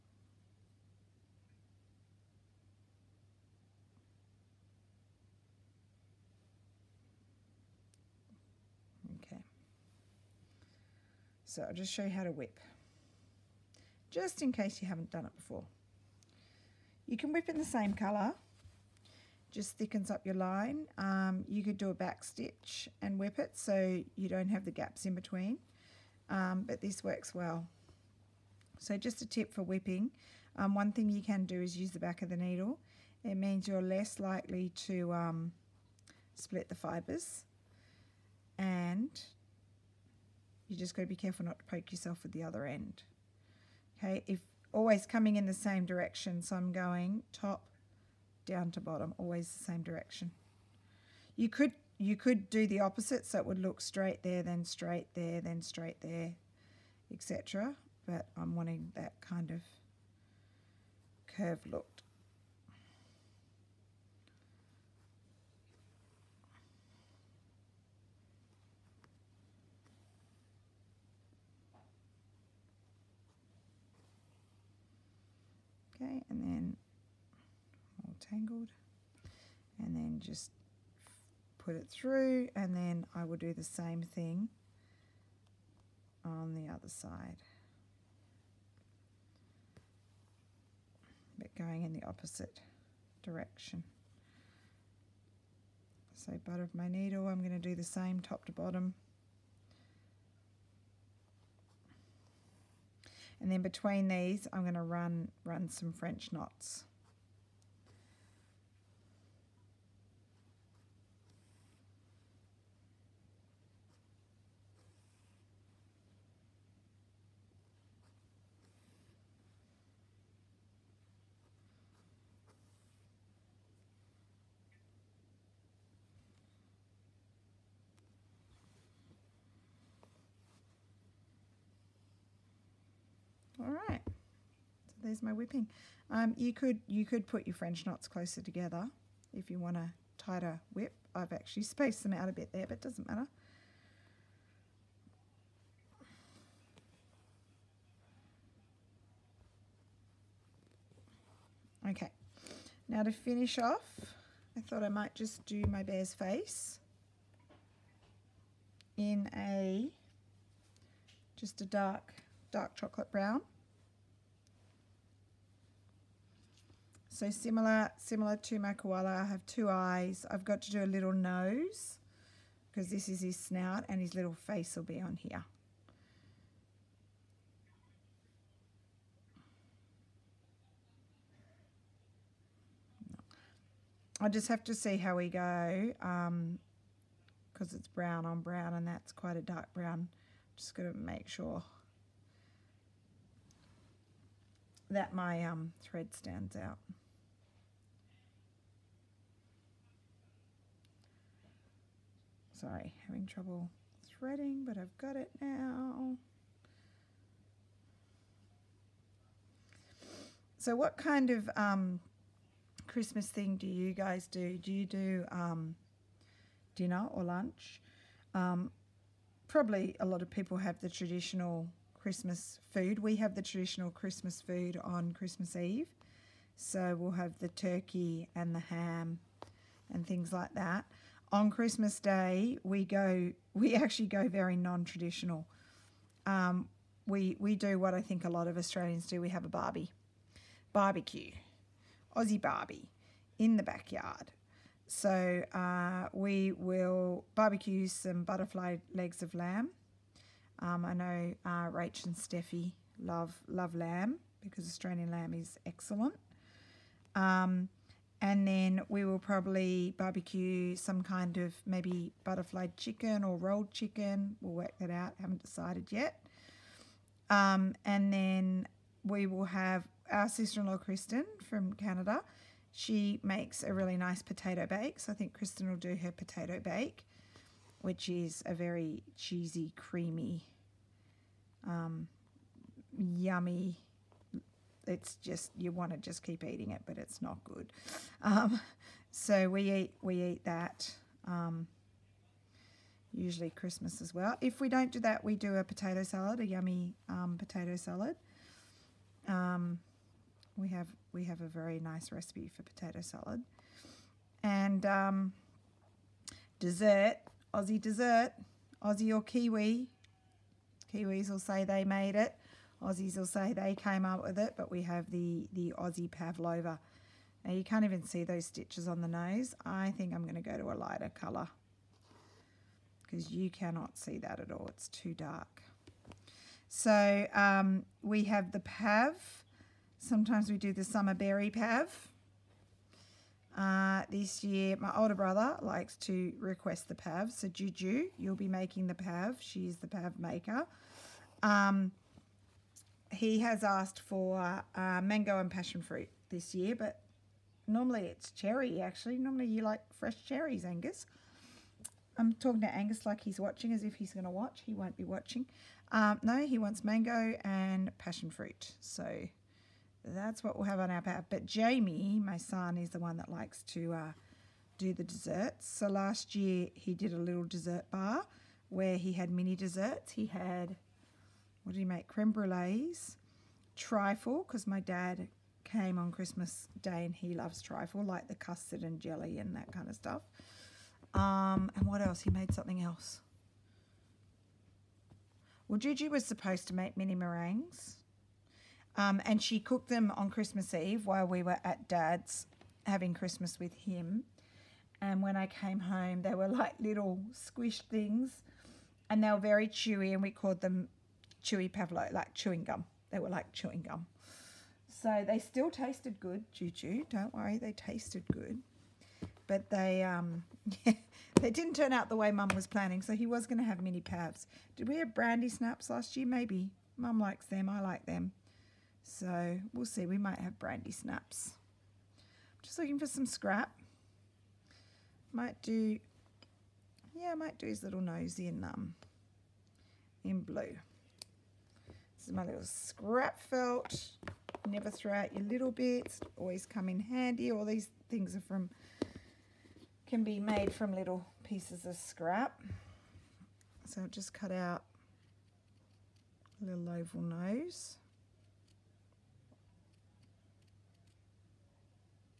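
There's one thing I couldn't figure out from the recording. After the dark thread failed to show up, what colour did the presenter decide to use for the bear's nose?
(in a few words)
blue.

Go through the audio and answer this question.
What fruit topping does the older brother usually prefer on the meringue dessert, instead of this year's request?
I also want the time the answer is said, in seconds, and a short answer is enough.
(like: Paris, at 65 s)
cherries, at 349 s.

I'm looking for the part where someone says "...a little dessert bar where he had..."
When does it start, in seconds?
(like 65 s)
367 s.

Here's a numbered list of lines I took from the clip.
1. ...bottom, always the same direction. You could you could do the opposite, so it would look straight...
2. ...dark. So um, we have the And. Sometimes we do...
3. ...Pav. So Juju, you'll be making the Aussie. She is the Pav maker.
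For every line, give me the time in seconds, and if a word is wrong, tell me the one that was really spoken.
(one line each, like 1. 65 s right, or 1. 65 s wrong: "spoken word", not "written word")
1. 48 s right
2. 325 s wrong: "Pav", not "And"
3. 336 s wrong: "Pav", not "Aussie".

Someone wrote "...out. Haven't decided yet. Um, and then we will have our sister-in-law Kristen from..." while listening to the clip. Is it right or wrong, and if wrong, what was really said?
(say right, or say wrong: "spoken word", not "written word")
right.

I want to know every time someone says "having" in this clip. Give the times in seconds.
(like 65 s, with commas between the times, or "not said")
203 s, 392 s.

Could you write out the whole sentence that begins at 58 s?
But I'm wanting that kind of curved look.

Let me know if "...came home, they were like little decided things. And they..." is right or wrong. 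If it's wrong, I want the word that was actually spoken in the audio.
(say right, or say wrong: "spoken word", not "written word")
wrong: "squished", not "decided".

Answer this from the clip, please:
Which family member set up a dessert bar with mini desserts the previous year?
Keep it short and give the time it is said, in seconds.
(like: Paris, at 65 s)
Jamie, at 361 s.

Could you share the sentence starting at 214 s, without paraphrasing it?
Do you do um, dinner or lunch?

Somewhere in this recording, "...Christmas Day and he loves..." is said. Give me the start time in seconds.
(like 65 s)
376 s.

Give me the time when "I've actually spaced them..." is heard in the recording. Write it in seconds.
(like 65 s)
141 s.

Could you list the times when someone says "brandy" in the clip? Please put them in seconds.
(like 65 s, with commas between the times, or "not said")
415 s, 420 s.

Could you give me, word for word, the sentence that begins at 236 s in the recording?
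Um, we we do what I think a lot of Australians do.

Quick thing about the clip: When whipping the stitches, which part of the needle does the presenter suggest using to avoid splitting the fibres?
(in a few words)
the back of the needle.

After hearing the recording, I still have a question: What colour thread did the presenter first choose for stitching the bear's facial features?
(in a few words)
dark chocolate brown.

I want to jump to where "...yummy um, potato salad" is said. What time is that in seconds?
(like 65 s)
296 s.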